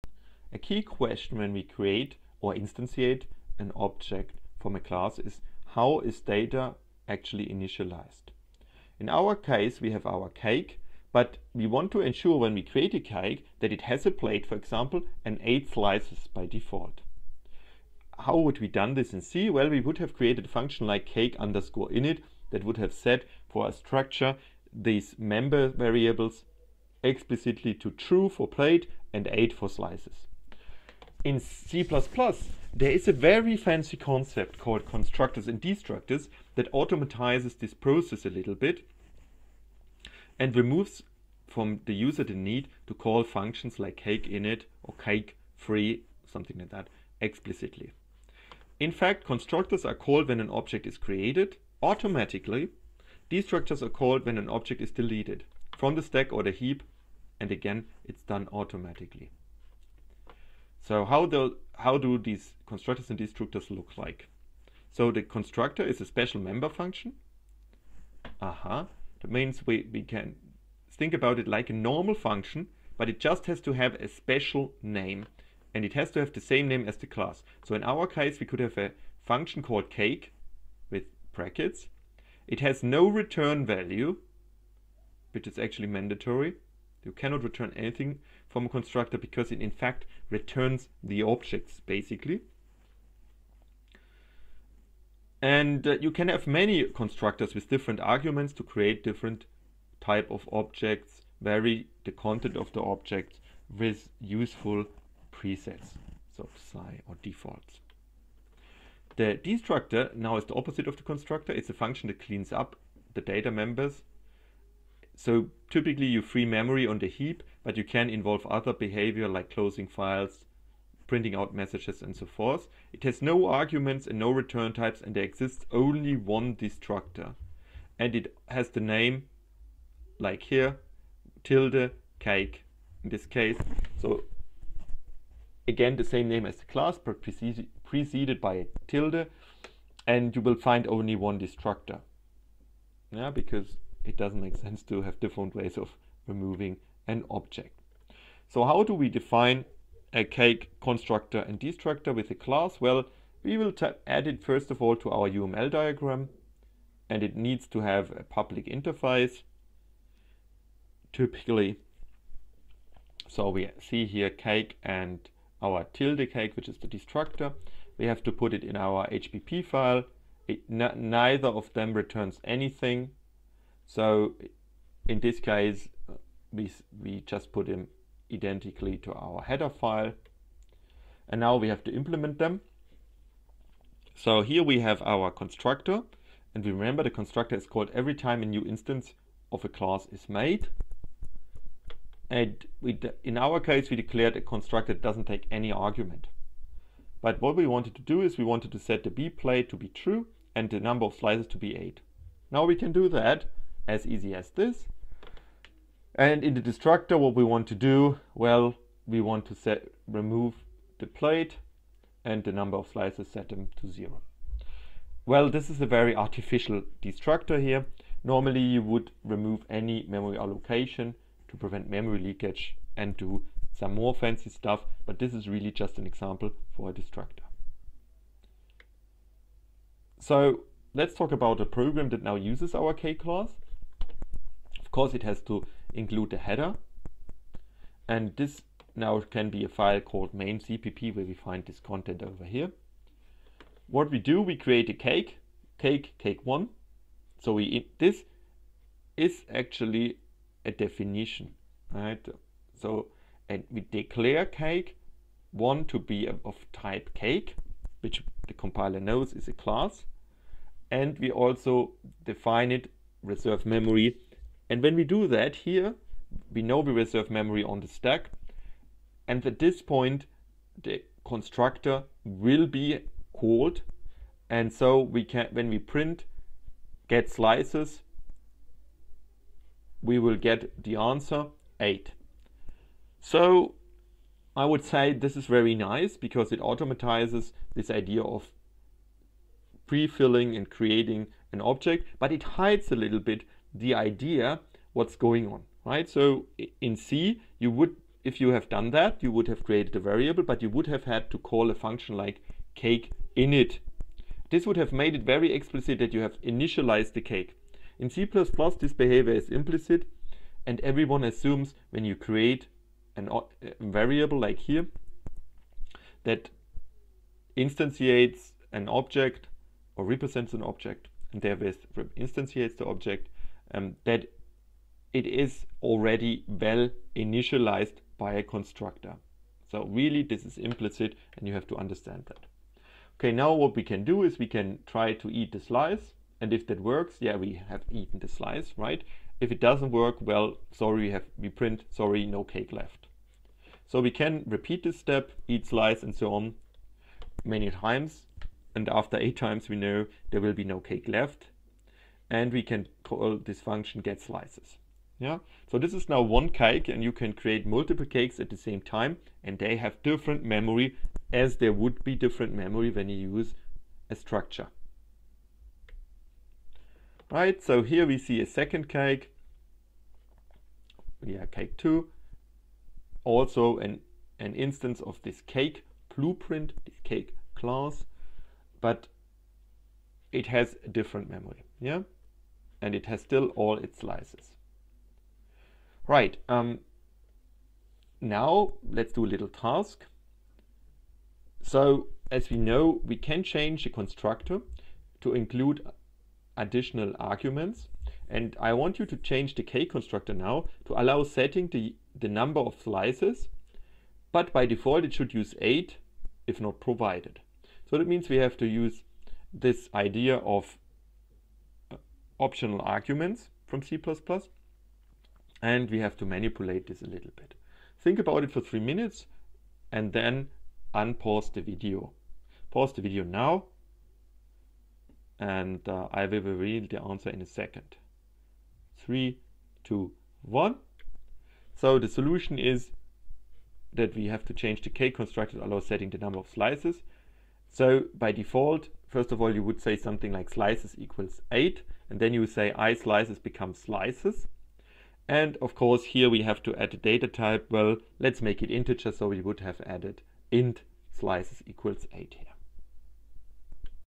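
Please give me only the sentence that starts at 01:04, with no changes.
So the constructor is a special member function.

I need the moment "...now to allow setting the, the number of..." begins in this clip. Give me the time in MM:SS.
06:40.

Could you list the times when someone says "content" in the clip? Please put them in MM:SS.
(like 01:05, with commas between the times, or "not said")
01:42, 04:01.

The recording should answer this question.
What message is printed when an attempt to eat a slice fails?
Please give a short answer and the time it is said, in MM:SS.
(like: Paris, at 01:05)
sorry, no cake left, at 05:41.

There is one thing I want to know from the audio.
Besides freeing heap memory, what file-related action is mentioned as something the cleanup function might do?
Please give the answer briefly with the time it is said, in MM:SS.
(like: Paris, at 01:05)
closing files, at 01:59.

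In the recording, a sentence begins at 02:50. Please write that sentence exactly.
It, neither of them returns anything so in this case, we, we just put them identically to our header file.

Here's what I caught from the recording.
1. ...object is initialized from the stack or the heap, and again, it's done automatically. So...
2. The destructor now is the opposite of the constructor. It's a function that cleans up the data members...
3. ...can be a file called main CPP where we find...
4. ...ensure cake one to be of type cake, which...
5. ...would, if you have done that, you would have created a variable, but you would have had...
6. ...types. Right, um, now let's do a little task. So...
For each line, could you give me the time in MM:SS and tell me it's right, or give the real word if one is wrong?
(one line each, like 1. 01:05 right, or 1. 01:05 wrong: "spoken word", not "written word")
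1. 00:54 wrong: "deleted", not "initialized"
2. 01:49 right
3. 03:59 right
4. 04:13 wrong: "declare", not "ensure"
5. 04:57 right
6. 06:23 wrong: "slices", not "types".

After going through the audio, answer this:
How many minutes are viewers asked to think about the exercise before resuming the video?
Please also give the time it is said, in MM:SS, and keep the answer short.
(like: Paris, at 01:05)
3, at 06:58.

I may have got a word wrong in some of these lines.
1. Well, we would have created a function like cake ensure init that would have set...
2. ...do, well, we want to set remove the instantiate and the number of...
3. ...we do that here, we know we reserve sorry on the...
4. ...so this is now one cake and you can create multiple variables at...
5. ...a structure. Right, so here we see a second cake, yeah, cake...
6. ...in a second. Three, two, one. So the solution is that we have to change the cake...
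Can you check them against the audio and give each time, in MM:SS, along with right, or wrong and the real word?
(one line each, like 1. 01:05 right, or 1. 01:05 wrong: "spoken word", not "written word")
1. 00:19 wrong: "underscore", not "ensure"
2. 03:27 wrong: "plate", not "instantiate"
3. 04:24 wrong: "memory", not "sorry"
4. 05:55 wrong: "cakes", not "variables"
5. 06:04 right
6. 07:07 right.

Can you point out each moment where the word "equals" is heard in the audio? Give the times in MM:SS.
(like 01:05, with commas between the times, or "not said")
07:20, 07:31.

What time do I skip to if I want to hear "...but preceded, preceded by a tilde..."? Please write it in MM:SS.
02:16.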